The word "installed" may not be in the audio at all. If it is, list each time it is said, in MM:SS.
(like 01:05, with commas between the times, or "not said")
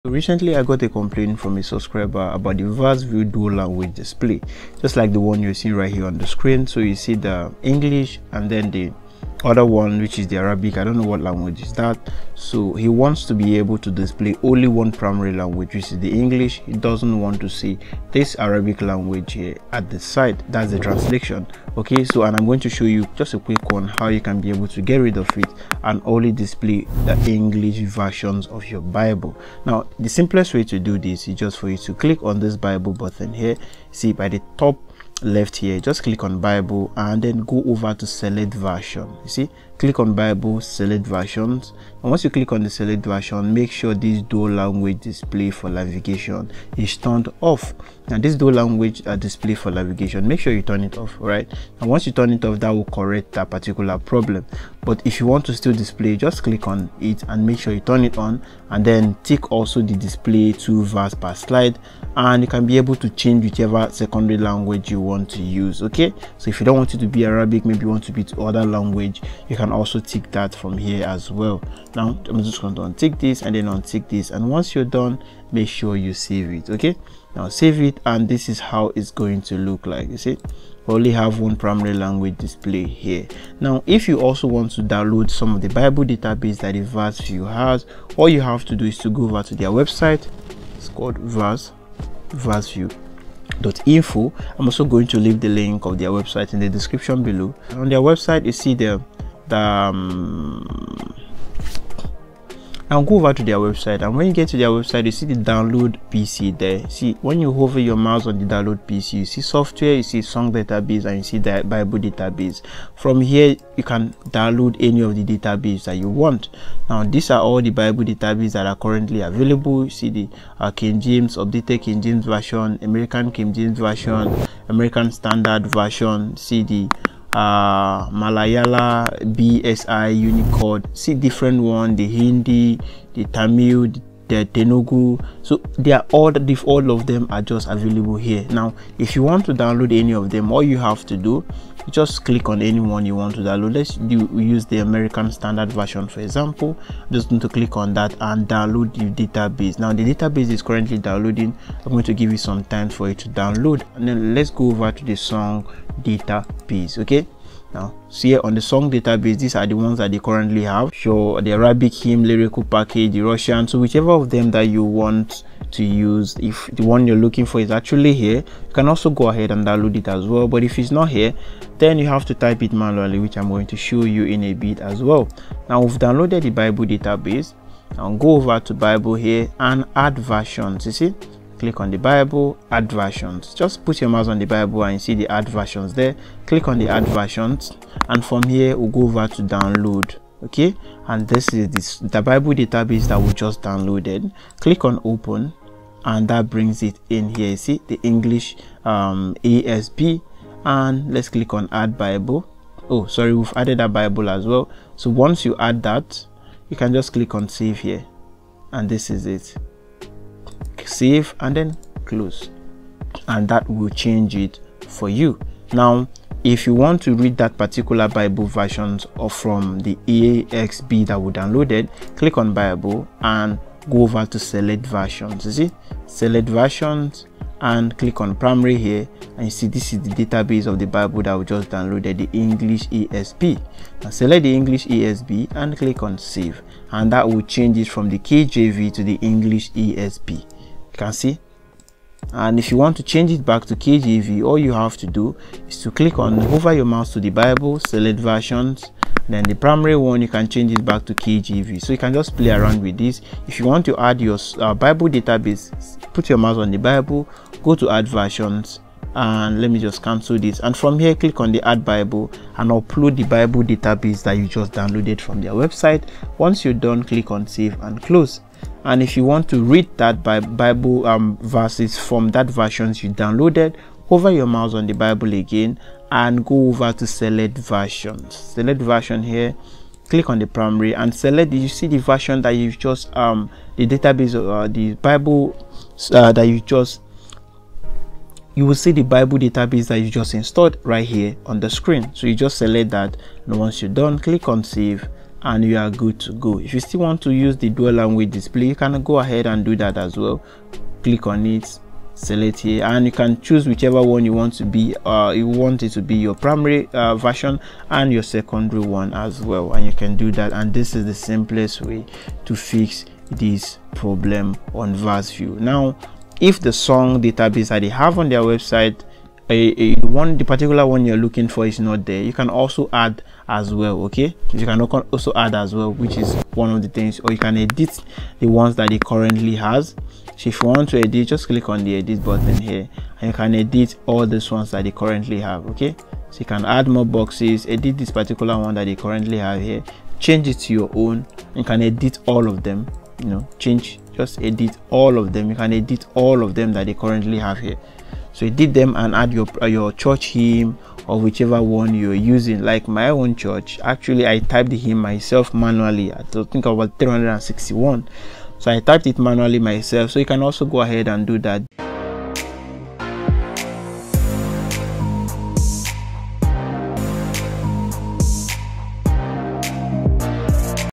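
04:50.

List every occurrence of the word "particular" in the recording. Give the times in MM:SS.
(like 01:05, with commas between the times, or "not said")
00:53, 03:37, 05:20, 05:38.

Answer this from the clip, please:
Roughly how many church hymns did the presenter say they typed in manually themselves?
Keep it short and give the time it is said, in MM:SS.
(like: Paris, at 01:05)
361, at 05:56.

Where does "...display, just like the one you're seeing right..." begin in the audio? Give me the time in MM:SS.
00:03.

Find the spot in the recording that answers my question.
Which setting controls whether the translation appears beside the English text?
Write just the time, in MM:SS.
00:44.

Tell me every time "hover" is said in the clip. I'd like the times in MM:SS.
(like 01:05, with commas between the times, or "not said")
01:47, 04:06, 04:34.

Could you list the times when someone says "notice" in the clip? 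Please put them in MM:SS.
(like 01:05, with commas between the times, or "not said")
not said.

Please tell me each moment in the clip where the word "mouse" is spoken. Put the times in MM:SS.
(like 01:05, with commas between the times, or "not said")
01:47, 03:04, 04:06, 04:16, 04:34.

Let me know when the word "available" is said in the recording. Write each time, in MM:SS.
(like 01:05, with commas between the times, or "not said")
01:59, 02:17.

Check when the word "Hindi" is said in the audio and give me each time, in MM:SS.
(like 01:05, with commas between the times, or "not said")
02:12.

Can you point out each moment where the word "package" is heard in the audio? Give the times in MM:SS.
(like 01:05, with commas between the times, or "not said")
02:42.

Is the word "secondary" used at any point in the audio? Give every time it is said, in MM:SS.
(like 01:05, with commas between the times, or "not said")
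01:03, 05:08.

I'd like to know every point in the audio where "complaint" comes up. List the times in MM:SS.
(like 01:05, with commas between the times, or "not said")
00:00.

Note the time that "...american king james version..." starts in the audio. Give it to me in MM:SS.
02:02.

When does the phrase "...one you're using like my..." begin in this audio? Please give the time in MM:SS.
05:51.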